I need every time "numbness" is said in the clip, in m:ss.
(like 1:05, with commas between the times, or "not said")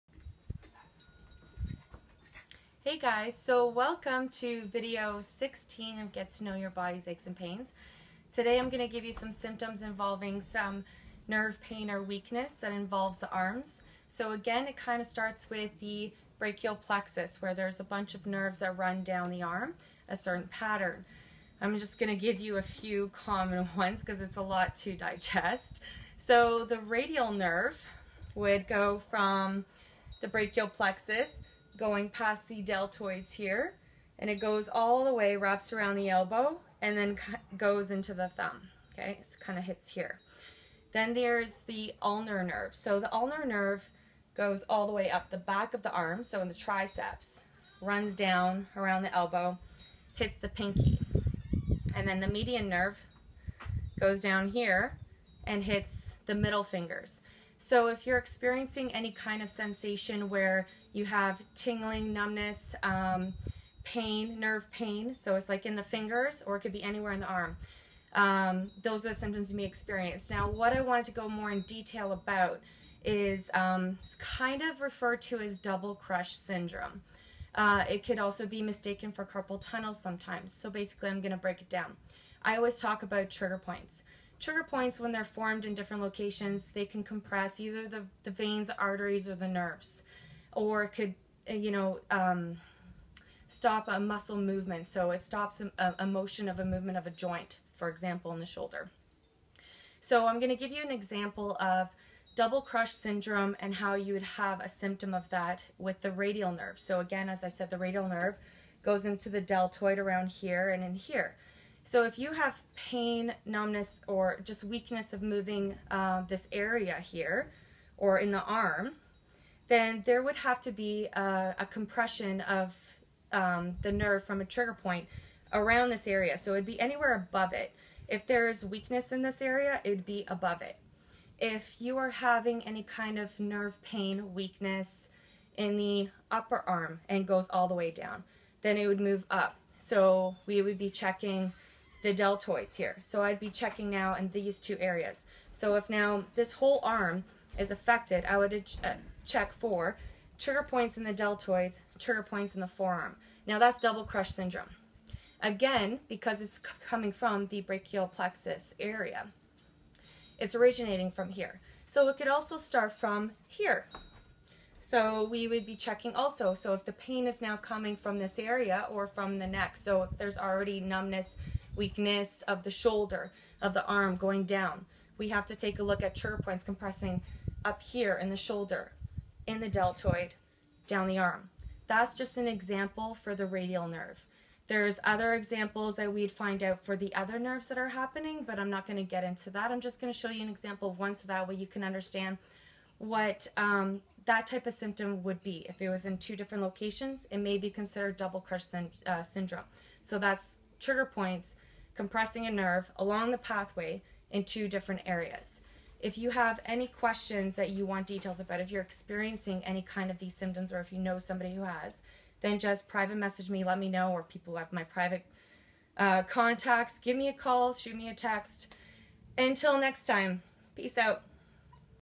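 1:02, 1:53, 2:50.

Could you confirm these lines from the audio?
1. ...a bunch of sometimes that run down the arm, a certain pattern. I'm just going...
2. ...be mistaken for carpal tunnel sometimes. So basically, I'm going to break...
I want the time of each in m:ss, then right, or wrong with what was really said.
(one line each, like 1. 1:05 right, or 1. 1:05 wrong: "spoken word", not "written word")
1. 0:17 wrong: "nerves", not "sometimes"
2. 1:18 right.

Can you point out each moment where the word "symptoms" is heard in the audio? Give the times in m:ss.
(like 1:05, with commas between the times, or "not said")
0:09, 1:09, 1:44, 3:14, 3:30.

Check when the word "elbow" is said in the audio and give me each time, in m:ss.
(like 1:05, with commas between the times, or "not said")
0:36, 0:49.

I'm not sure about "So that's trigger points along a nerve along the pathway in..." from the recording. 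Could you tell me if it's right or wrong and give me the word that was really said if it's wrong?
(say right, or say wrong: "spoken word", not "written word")
wrong: "compressing", not "along".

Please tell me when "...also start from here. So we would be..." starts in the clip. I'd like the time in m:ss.
2:42.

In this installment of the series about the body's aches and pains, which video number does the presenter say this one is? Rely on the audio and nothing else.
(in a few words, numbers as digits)
16.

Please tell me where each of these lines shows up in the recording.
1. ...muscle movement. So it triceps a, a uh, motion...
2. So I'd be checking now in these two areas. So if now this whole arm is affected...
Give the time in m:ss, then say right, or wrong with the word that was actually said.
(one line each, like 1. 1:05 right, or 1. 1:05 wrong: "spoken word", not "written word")
1. 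1:33 wrong: "stops", not "triceps"
2. 2:23 right.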